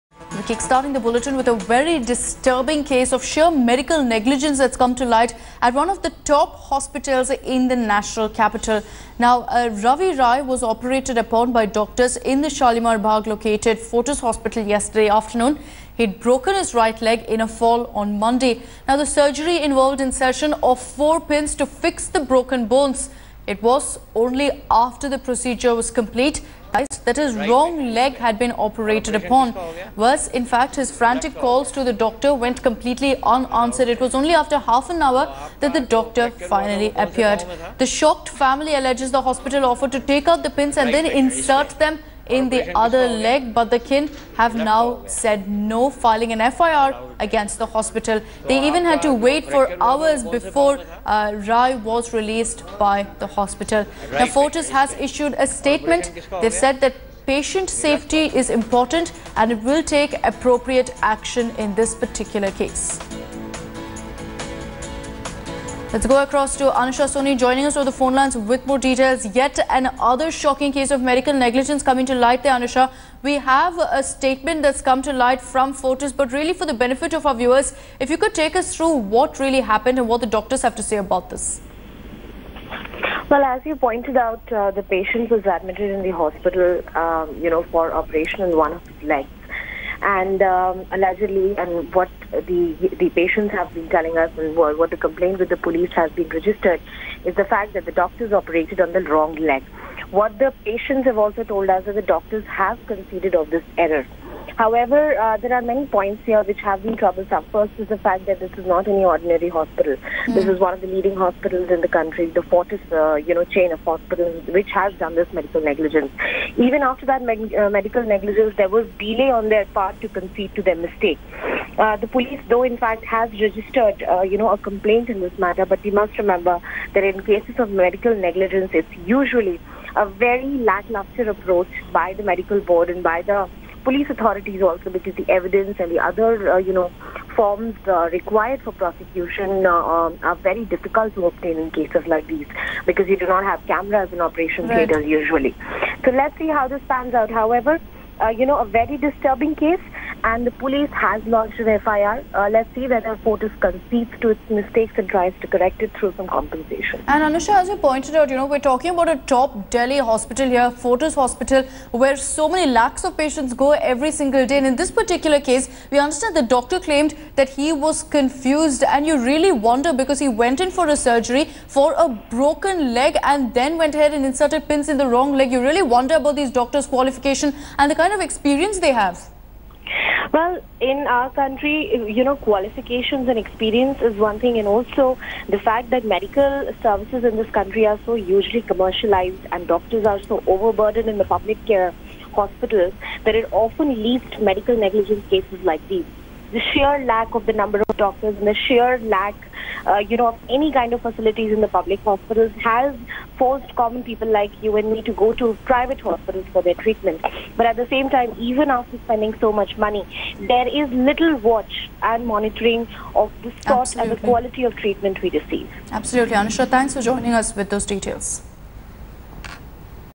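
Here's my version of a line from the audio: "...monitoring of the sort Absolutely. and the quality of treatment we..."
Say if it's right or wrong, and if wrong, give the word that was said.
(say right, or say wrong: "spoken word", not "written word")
right.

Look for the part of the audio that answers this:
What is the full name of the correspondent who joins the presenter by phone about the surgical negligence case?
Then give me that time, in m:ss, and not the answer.
1:06.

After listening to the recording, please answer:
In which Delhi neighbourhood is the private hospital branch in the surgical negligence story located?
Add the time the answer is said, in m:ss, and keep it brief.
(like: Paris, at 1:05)
Shalimar Bagh, at 0:12.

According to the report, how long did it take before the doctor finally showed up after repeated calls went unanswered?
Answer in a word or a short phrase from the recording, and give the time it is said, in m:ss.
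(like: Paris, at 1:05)
Half an hour, at 0:34.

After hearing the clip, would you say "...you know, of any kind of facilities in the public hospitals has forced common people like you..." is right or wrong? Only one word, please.
right.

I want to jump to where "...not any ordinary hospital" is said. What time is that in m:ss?
1:48.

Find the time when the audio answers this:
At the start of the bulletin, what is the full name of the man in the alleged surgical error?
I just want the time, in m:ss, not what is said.
0:09.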